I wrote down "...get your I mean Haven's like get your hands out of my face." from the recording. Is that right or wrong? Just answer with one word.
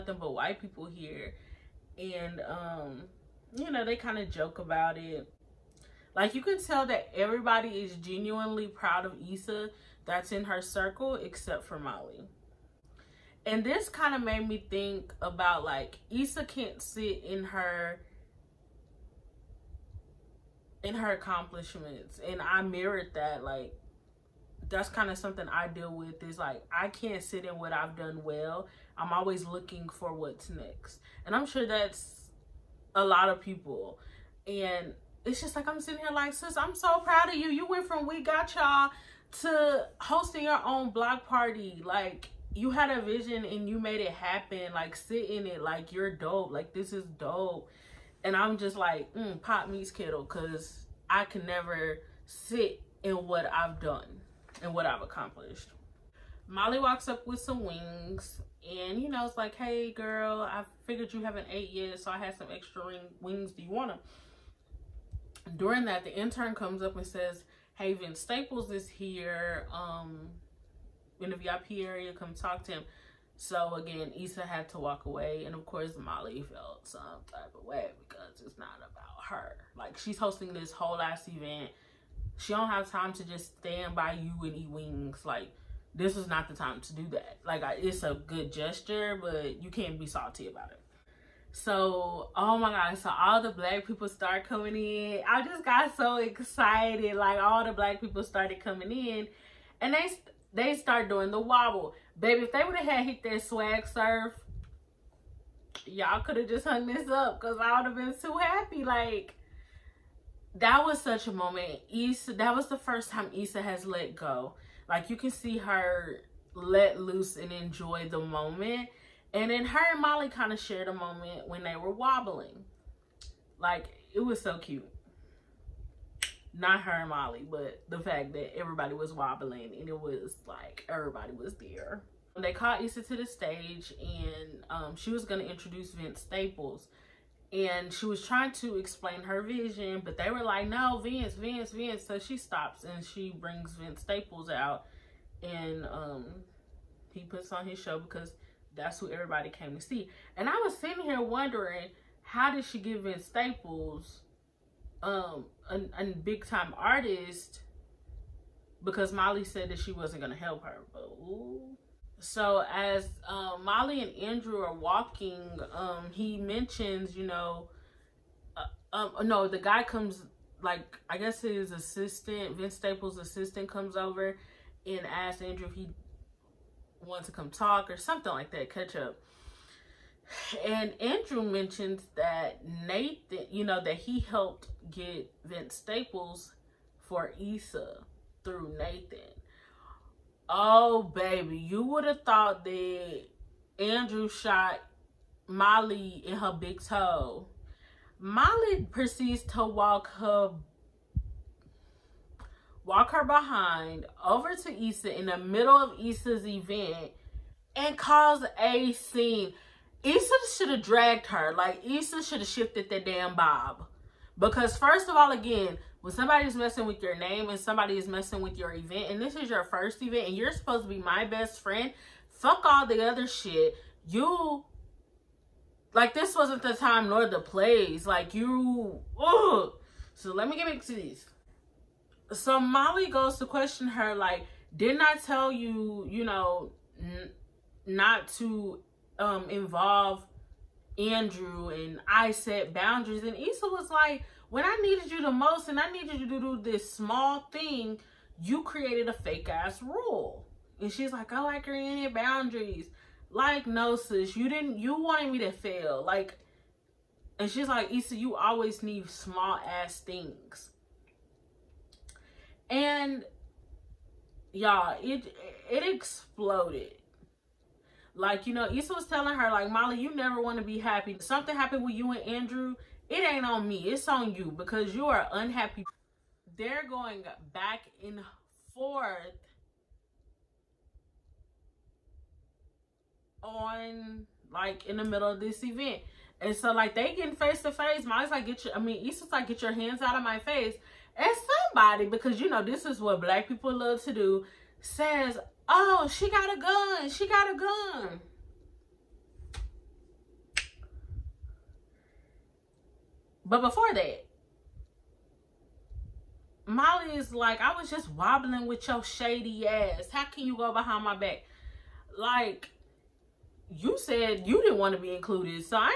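wrong.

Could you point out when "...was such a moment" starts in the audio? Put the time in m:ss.
1:50.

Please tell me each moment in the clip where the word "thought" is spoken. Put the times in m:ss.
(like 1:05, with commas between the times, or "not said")
3:12.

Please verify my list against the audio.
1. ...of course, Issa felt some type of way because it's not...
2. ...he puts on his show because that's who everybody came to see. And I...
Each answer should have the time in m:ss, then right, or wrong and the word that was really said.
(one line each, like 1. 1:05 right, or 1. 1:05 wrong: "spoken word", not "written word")
1. 1:15 wrong: "Molly", not "Issa"
2. 2:27 right.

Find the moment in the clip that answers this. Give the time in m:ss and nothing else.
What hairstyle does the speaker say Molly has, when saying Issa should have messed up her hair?
3:33.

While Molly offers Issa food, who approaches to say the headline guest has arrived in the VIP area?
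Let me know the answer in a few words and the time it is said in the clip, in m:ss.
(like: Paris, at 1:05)
the intern, at 1:06.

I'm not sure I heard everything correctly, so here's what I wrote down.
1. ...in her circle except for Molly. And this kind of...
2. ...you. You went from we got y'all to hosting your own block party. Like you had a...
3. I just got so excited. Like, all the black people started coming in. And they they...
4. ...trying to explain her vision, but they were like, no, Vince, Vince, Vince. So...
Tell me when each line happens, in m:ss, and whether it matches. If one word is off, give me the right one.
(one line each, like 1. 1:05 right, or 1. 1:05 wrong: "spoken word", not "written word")
1. 0:10 right
2. 0:37 right
3. 1:35 right
4. 2:18 right.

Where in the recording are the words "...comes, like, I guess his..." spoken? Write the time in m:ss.
2:49.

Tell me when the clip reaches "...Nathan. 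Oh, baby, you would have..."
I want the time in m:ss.
3:08.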